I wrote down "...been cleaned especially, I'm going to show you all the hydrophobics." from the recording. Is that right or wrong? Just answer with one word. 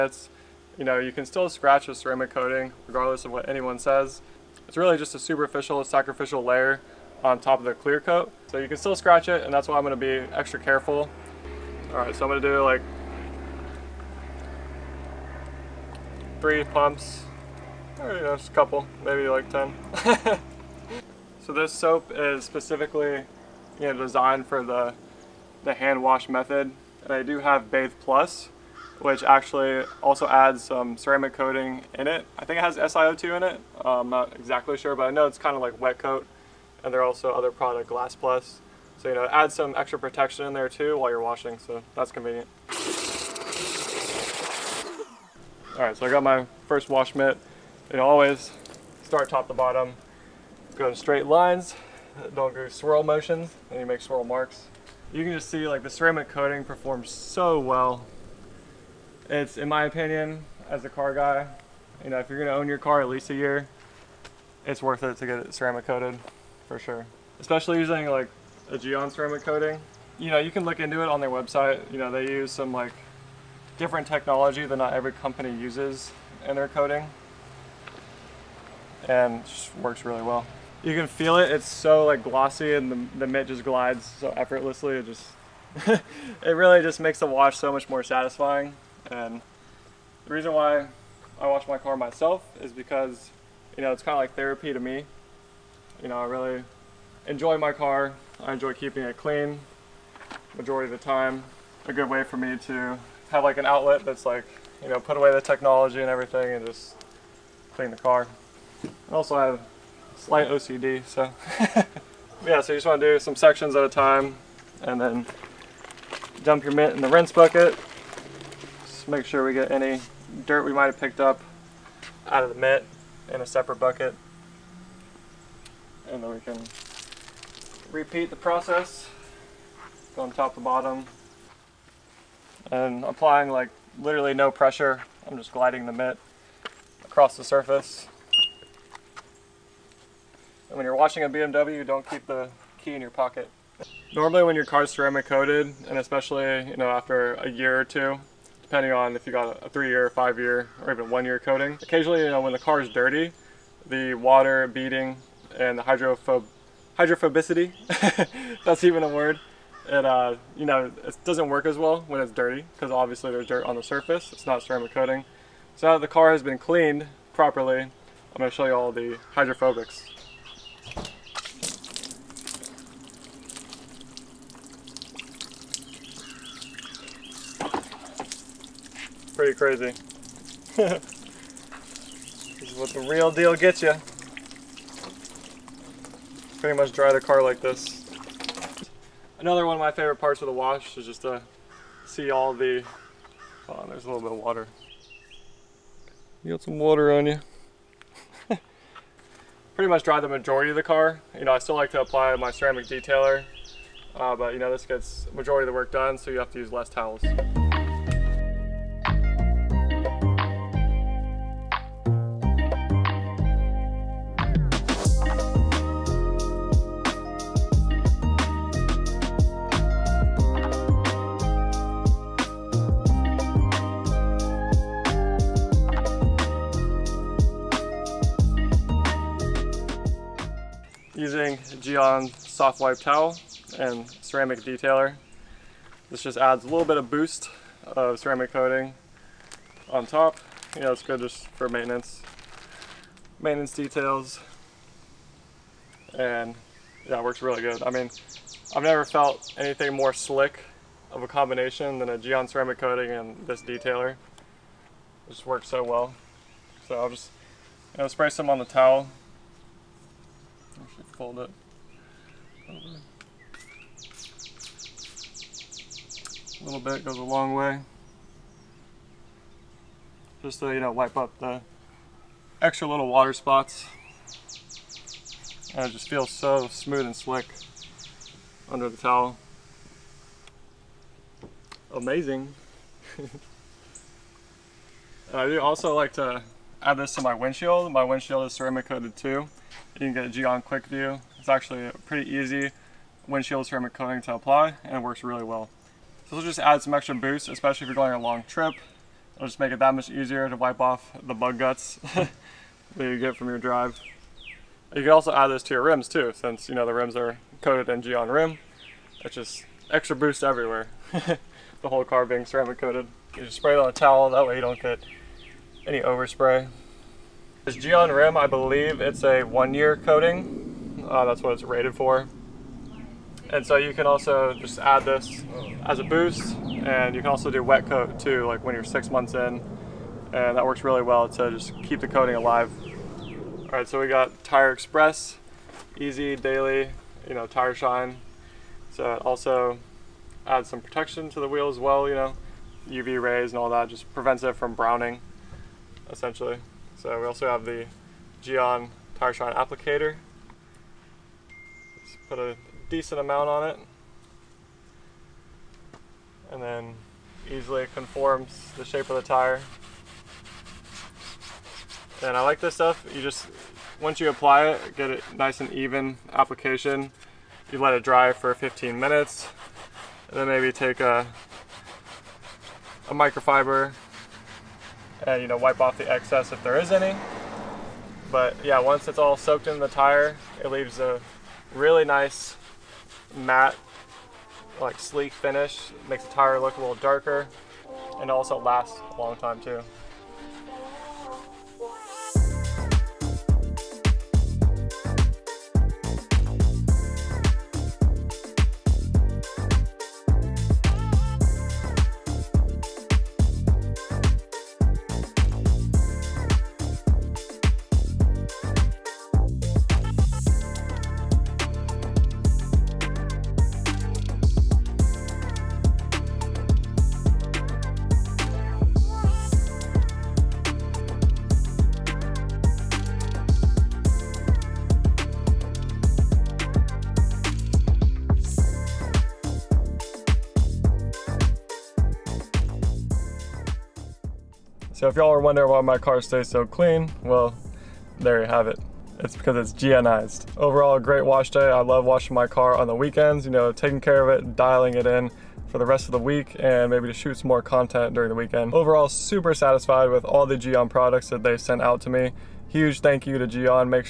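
wrong.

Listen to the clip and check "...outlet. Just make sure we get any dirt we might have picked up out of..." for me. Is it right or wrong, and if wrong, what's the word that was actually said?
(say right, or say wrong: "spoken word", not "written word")
wrong: "bucket", not "outlet".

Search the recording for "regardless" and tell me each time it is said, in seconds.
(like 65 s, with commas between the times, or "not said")
2 s.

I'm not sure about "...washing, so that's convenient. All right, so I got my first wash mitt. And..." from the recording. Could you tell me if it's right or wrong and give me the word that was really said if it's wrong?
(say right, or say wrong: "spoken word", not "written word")
right.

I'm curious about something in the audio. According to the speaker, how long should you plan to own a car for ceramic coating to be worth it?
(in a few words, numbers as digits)
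at least a year.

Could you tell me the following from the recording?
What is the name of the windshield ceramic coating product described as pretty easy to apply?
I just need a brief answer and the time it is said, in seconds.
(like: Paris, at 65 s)
Quick View, at 290 s.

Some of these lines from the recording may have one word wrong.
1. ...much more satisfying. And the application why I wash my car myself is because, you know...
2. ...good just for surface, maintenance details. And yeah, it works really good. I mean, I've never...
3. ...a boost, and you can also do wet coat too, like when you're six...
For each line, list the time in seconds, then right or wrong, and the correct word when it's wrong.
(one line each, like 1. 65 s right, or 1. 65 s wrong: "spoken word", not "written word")
1. 87 s wrong: "reason", not "application"
2. 241 s wrong: "maintenance", not "surface"
3. 325 s right.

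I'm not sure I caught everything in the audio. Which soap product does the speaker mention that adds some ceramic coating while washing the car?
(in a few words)
Bathe Plus.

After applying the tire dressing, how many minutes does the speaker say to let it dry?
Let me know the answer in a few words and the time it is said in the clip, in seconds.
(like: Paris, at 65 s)
15, at 368 s.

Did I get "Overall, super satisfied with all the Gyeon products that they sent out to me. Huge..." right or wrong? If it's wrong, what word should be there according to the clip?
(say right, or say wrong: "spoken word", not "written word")
right.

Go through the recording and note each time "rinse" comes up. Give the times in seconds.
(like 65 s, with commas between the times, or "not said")
117 s.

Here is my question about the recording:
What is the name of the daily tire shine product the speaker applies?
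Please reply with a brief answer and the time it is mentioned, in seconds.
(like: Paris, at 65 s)
Tire Express, at 334 s.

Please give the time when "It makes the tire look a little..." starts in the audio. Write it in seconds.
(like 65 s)
385 s.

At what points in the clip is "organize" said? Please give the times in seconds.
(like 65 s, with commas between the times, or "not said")
not said.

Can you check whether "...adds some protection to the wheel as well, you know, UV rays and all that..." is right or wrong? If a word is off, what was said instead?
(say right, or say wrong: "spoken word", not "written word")
right.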